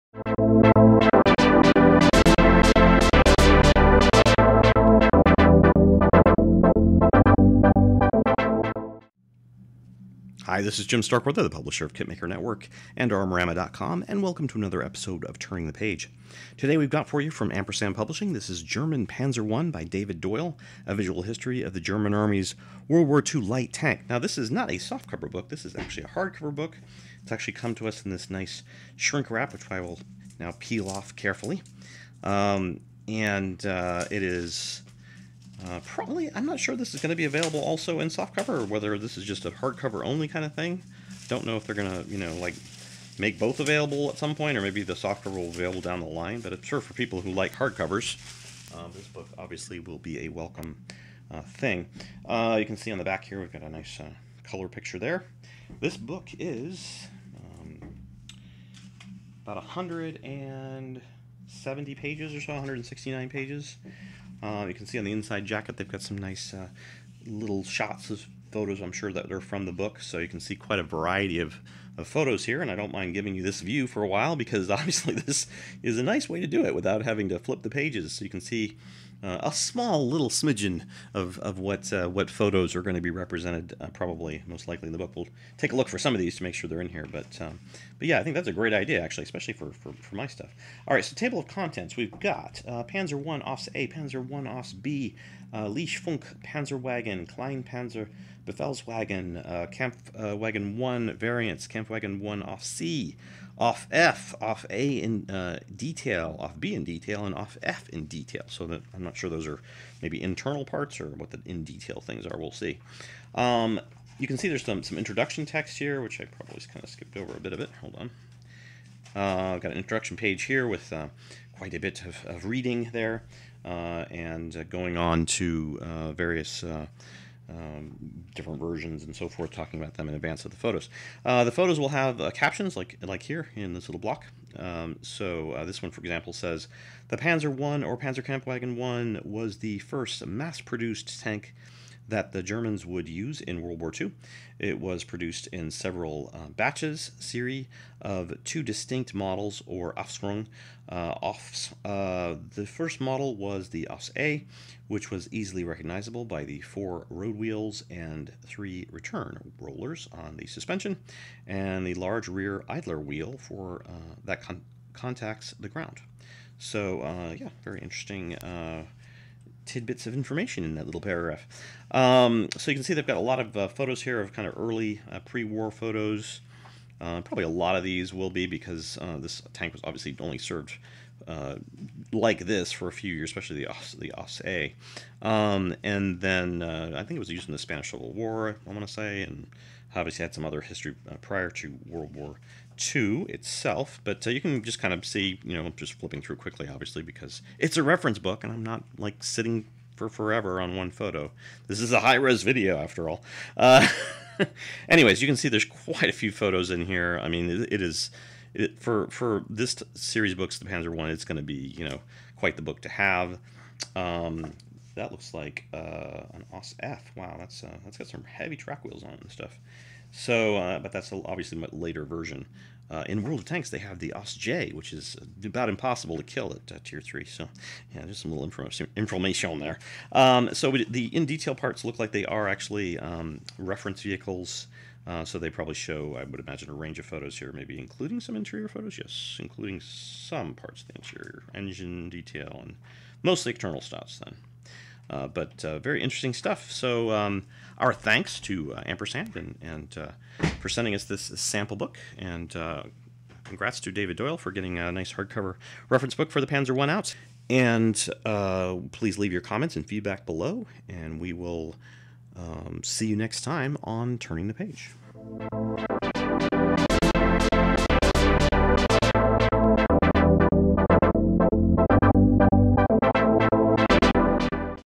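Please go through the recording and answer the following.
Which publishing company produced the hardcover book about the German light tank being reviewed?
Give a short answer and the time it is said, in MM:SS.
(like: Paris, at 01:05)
Ampersand Publishing, at 00:17.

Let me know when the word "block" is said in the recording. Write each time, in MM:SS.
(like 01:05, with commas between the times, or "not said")
02:13.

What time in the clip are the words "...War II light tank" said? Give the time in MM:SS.
00:23.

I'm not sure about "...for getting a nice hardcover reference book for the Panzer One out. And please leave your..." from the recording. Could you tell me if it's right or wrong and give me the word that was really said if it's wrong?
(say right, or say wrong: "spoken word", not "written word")
right.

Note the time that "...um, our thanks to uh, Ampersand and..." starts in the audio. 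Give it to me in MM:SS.
04:07.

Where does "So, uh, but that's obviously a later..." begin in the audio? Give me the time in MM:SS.
03:40.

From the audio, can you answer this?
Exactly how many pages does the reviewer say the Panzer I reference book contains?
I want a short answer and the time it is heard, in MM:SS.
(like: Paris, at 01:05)
169, at 01:02.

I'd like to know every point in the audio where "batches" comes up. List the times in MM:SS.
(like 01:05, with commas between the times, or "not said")
02:26.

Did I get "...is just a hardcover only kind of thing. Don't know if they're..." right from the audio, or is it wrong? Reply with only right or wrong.
right.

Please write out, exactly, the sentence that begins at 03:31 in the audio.
It's going to be you know quite the book to have.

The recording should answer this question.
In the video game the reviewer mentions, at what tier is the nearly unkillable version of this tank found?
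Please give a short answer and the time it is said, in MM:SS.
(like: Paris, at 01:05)
Tier 3, at 03:46.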